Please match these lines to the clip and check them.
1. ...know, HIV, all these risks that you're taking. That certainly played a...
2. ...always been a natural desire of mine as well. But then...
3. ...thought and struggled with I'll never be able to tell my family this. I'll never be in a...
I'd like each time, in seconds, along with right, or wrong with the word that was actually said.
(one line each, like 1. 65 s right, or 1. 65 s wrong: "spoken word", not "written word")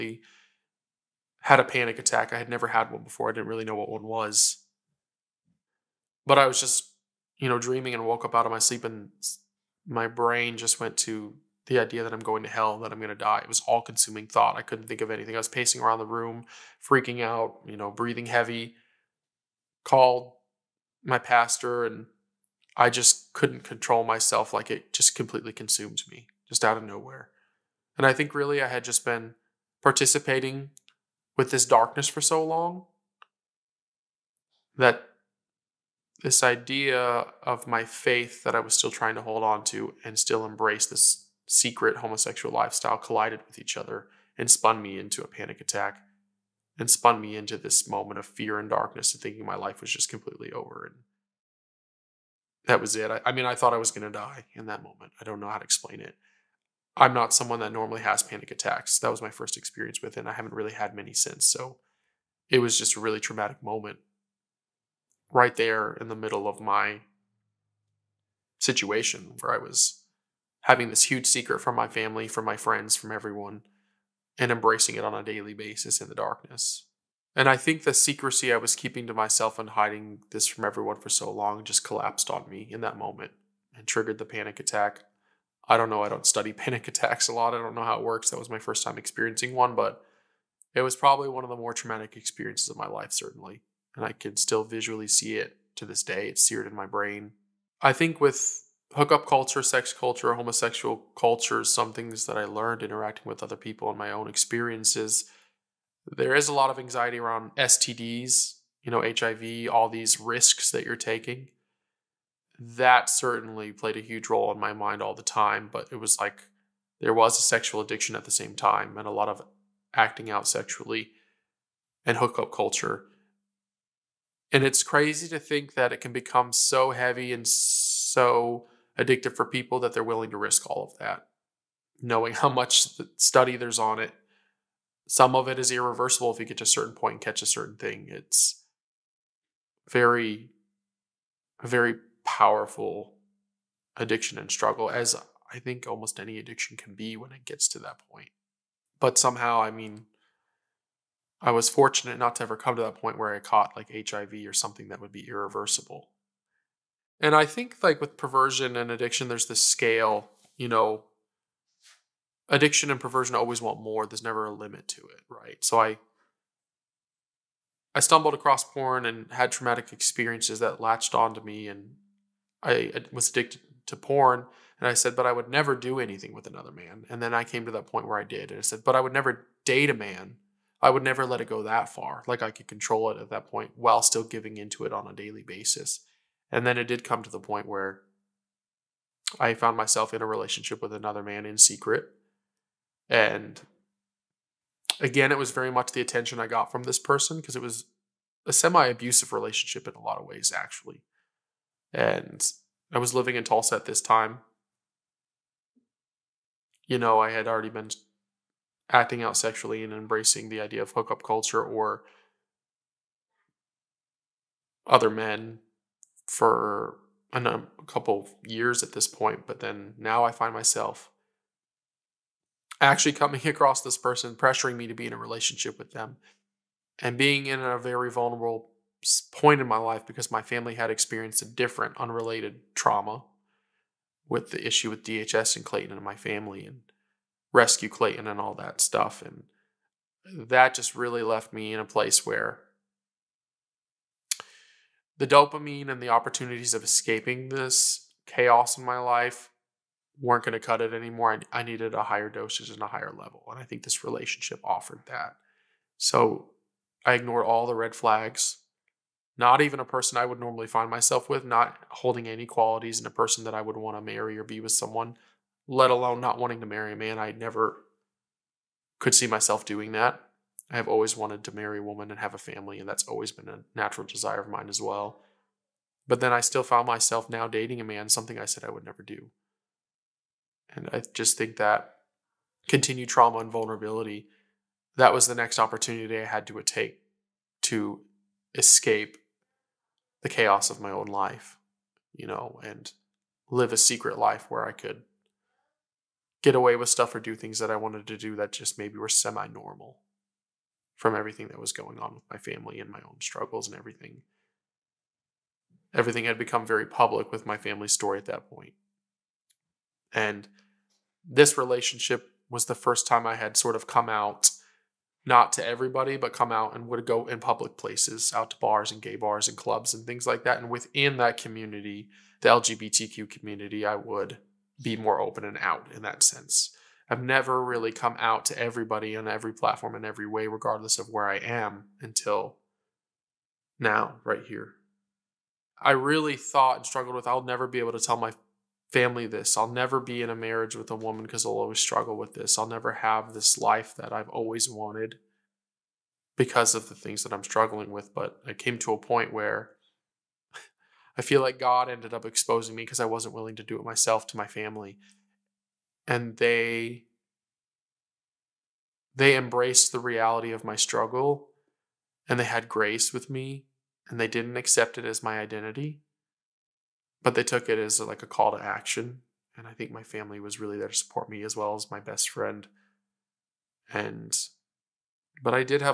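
1. 108 s right
2. 273 s right
3. 336 s right.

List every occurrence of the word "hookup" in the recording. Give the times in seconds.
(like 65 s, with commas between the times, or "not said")
98 s, 122 s, 210 s.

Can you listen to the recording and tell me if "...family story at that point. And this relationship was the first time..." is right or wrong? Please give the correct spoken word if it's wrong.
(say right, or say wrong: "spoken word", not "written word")
right.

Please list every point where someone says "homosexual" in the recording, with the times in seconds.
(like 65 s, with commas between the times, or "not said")
41 s, 100 s.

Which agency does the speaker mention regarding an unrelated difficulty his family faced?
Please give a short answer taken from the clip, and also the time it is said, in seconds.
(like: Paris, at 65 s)
DHS, at 235 s.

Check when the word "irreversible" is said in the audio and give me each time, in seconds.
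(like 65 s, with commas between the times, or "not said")
135 s, 155 s.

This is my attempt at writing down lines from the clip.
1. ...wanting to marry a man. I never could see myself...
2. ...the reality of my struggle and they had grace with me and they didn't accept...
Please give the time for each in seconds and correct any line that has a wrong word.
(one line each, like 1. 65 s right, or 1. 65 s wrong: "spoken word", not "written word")
1. 266 s right
2. 359 s right.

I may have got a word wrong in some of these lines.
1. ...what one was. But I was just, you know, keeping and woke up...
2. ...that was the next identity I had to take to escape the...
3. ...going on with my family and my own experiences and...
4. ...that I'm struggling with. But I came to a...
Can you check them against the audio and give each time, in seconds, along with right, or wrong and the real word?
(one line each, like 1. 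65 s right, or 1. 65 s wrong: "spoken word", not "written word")
1. 3 s wrong: "dreaming", not "keeping"
2. 284 s wrong: "opportunity", not "identity"
3. 301 s wrong: "struggles", not "experiences"
4. 347 s right.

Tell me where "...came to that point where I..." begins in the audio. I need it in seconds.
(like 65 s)
177 s.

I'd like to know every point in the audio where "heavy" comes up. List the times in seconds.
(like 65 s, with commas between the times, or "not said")
18 s, 126 s.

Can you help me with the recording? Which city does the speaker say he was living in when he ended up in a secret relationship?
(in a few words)
Tulsa.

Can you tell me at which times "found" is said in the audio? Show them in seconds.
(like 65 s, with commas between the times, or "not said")
189 s, 276 s.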